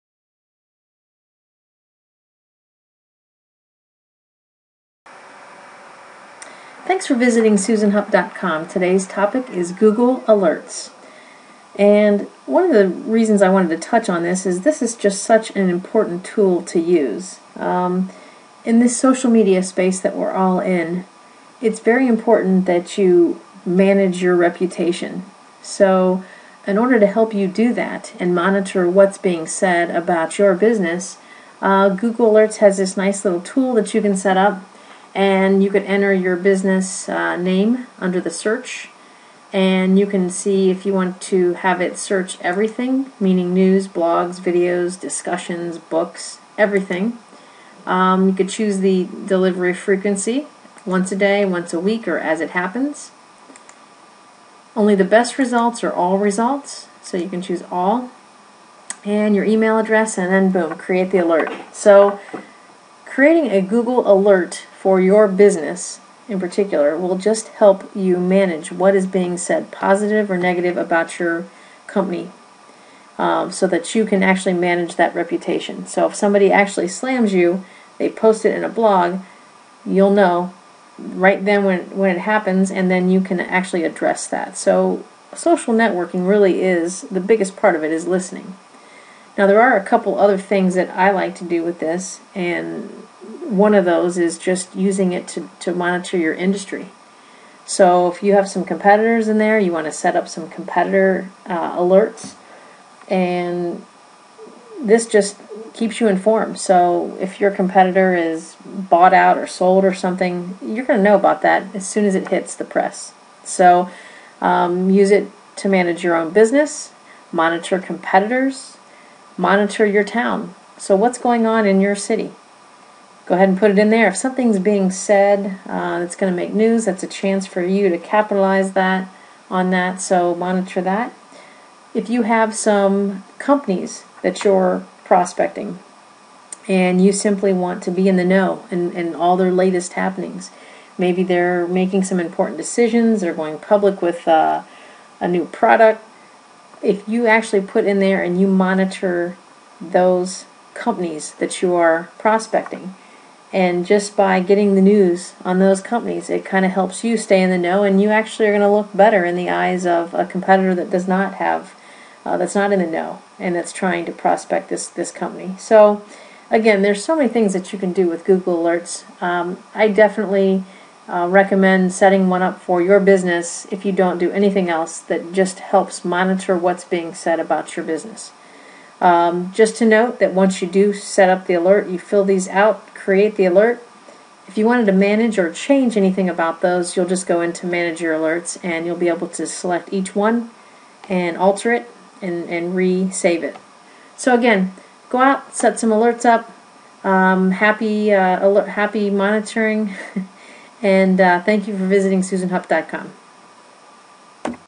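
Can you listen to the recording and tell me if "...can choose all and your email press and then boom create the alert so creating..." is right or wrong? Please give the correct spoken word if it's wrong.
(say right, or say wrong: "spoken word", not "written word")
wrong: "address", not "press".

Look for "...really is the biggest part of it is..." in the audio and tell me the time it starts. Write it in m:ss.
1:26.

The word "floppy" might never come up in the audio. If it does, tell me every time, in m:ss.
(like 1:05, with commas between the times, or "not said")
not said.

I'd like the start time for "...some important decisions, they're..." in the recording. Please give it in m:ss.
2:22.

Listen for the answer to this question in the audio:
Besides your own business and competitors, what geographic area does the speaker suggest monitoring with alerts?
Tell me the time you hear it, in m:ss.
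1:59.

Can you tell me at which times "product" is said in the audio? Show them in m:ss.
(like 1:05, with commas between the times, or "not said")
2:25.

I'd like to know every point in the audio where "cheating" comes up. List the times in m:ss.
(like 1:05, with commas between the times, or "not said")
not said.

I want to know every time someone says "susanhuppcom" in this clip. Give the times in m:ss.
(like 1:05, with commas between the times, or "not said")
0:07, 3:22.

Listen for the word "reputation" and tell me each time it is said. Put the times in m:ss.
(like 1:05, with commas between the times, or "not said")
0:24, 1:15.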